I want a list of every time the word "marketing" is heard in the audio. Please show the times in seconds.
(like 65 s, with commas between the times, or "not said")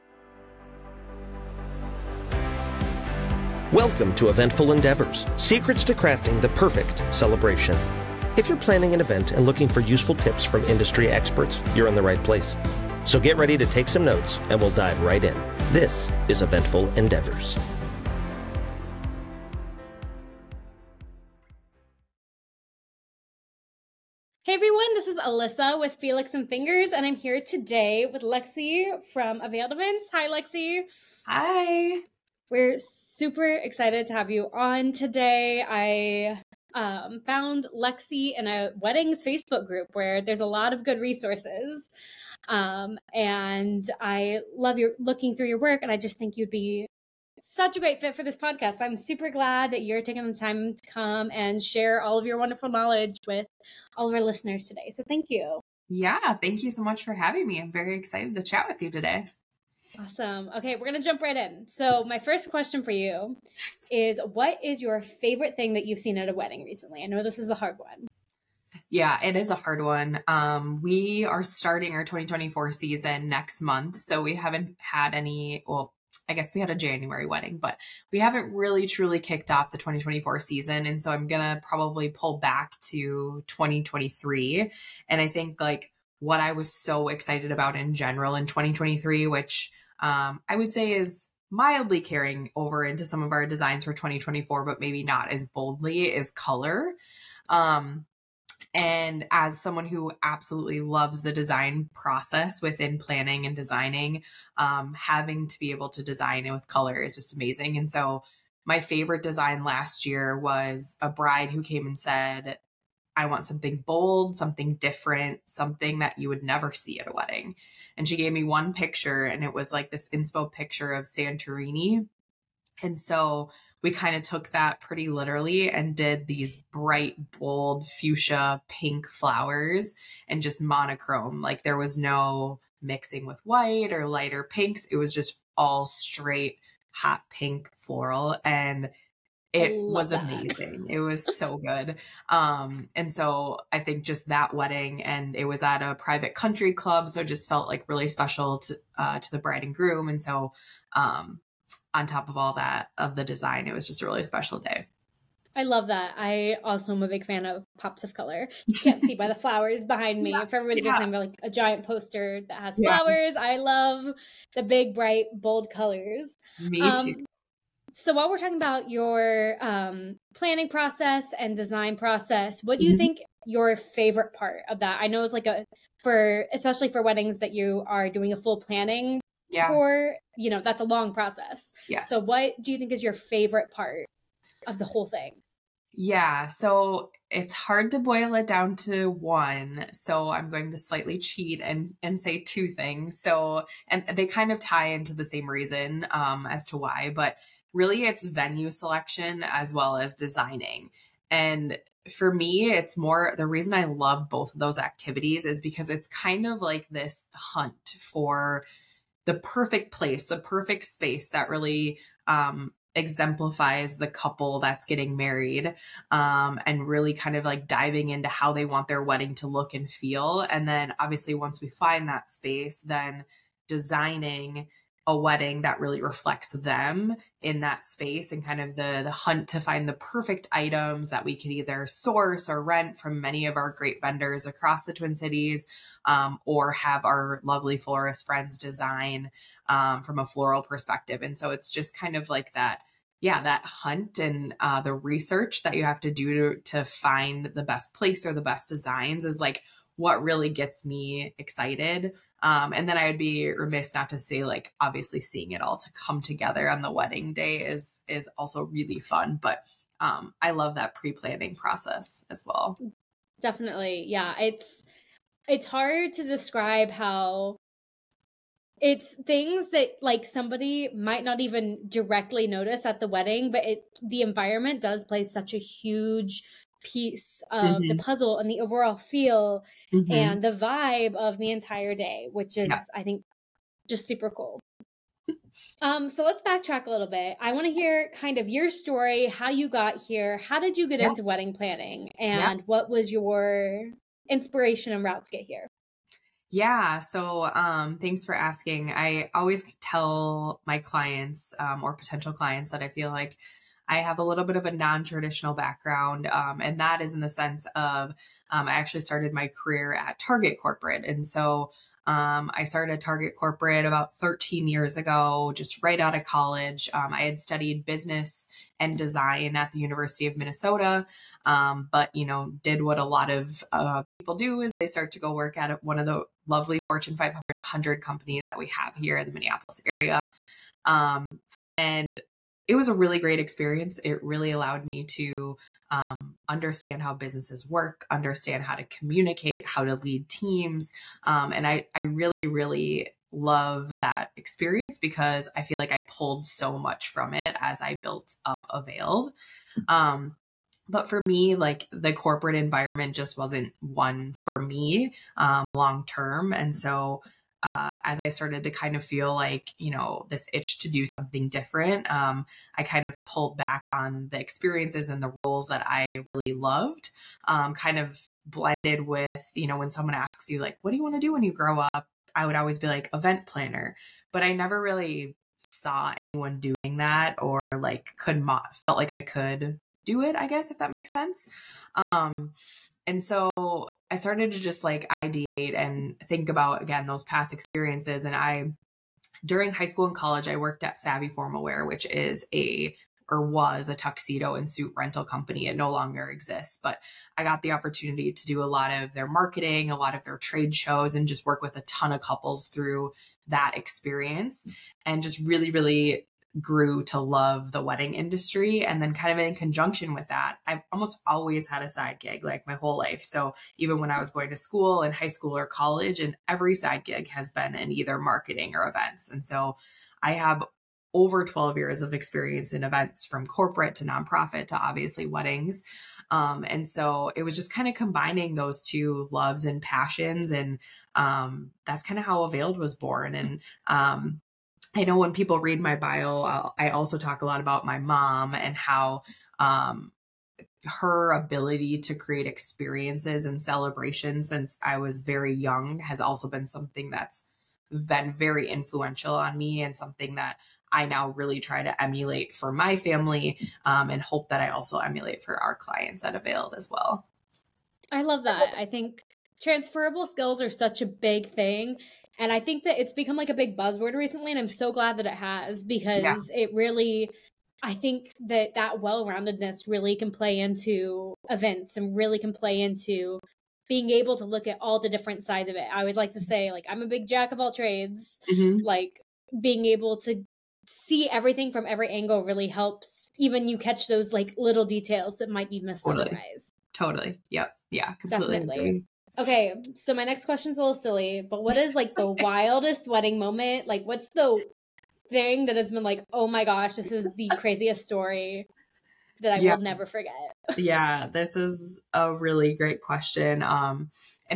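399 s, 418 s.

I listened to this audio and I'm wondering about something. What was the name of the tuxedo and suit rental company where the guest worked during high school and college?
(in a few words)
Savvi Formal Wear.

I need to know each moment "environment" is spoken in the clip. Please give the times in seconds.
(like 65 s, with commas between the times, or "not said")
274 s, 352 s.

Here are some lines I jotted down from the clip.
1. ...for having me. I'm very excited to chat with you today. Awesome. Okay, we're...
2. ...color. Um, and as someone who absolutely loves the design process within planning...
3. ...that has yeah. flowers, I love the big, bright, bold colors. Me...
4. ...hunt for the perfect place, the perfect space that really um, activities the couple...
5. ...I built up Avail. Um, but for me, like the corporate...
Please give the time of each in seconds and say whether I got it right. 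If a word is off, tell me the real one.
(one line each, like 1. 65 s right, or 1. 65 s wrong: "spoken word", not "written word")
1. 57 s right
2. 96 s right
3. 162 s right
4. 207 s wrong: "exemplifies", not "activities"
5. 347 s right.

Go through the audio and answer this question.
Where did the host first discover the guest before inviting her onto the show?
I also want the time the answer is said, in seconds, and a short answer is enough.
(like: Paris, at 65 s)
weddings Facebook group, at 38 s.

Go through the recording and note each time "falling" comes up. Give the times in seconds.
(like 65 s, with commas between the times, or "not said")
not said.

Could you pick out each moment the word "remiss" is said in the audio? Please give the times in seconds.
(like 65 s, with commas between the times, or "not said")
253 s.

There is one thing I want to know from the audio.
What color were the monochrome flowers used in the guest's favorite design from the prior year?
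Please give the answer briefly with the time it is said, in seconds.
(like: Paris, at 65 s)
fuchsia pink, at 127 s.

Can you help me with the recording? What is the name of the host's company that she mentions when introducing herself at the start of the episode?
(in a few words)
Felix and Fingers.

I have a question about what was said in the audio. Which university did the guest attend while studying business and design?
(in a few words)
University of Minnesota.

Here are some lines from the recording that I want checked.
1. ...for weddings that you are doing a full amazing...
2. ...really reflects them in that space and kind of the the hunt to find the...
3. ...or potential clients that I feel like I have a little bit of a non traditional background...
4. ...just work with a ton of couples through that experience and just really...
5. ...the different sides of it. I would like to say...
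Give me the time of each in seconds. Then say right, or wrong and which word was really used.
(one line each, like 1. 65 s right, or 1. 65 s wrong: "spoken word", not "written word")
1. 176 s wrong: "planning", not "amazing"
2. 225 s right
3. 301 s right
4. 401 s right
5. 474 s right.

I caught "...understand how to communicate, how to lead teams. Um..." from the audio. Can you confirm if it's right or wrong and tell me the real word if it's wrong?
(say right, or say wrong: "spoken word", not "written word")
right.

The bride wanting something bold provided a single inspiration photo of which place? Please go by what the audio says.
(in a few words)
Santorini.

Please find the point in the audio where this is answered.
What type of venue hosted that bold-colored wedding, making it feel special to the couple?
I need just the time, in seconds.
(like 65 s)
145 s.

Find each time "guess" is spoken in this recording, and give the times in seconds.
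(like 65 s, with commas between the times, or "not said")
76 s, 380 s.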